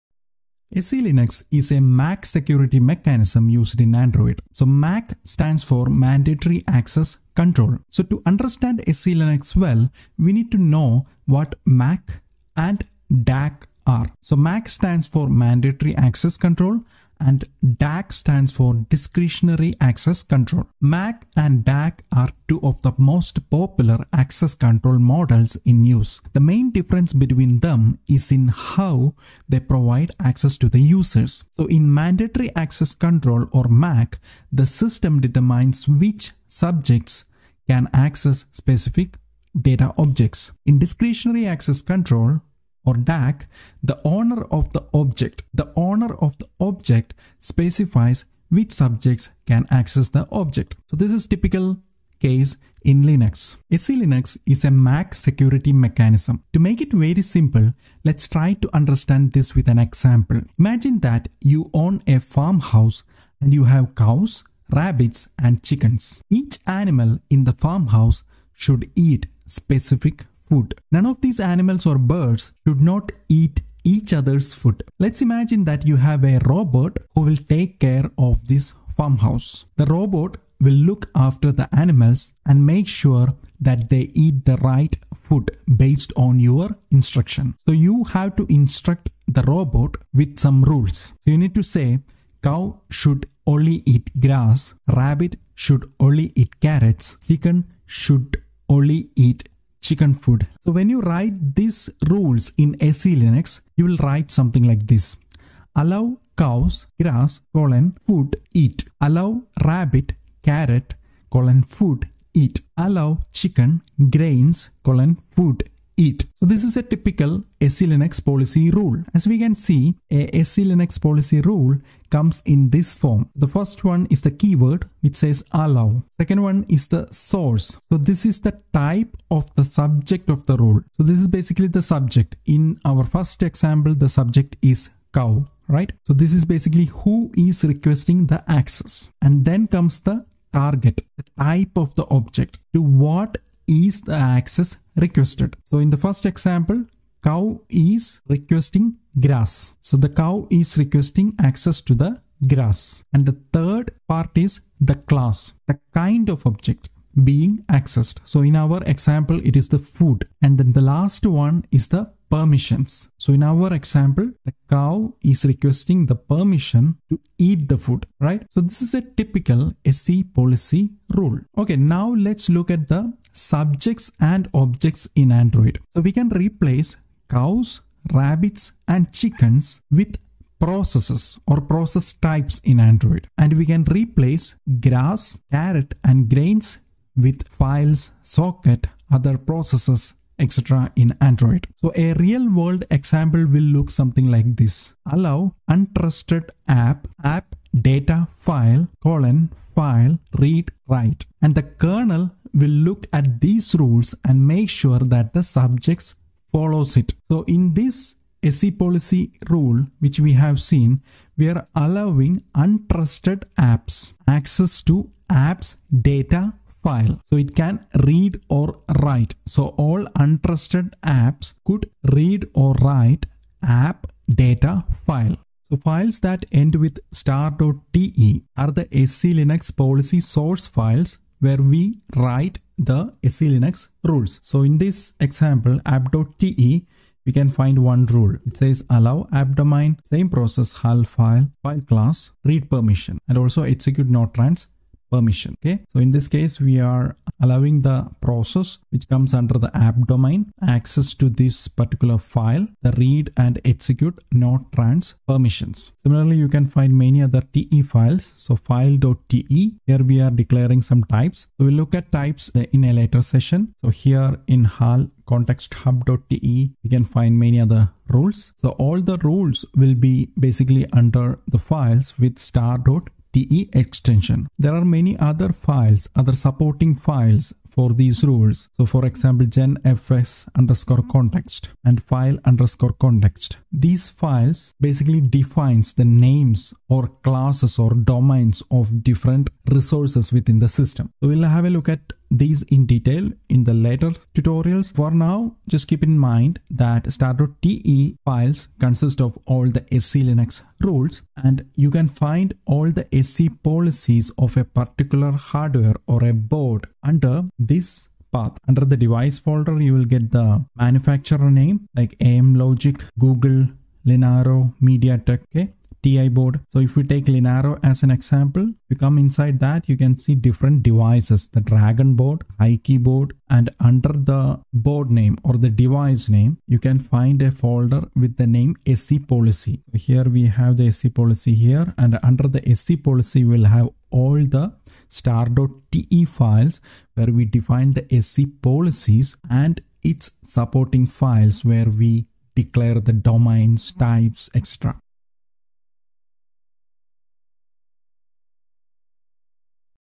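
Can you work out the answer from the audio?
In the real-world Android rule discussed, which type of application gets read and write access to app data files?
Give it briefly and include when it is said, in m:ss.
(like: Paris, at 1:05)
untrusted app, at 3:15.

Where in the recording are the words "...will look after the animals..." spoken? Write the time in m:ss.
1:20.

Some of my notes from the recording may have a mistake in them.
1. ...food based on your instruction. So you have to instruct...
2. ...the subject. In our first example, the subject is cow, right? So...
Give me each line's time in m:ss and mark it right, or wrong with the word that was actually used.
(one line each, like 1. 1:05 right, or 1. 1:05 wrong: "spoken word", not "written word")
1. 1:25 right
2. 2:11 right.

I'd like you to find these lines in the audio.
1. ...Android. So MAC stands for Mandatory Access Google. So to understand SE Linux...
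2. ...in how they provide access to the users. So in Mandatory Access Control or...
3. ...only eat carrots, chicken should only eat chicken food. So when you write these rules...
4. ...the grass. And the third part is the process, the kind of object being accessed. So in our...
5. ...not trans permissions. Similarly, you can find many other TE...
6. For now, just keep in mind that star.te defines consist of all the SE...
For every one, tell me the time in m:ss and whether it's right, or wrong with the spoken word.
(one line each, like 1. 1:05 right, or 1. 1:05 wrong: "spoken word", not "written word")
1. 0:03 wrong: "Control", not "Google"
2. 0:28 right
3. 1:35 right
4. 2:31 wrong: "class", not "process"
5. 4:14 right
6. 4:54 wrong: "files", not "defines".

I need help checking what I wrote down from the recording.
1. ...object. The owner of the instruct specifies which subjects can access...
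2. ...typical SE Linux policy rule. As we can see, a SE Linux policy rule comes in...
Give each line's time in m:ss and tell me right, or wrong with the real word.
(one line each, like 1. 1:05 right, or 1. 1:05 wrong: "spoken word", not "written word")
1. 0:44 wrong: "object", not "instruct"
2. 1:56 right.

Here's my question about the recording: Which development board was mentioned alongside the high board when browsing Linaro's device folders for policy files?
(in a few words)
Dragon board.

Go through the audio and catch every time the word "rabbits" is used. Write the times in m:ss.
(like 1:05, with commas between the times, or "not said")
1:04, 1:34, 1:49, 2:58.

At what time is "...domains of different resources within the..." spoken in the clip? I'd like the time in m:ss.
4:47.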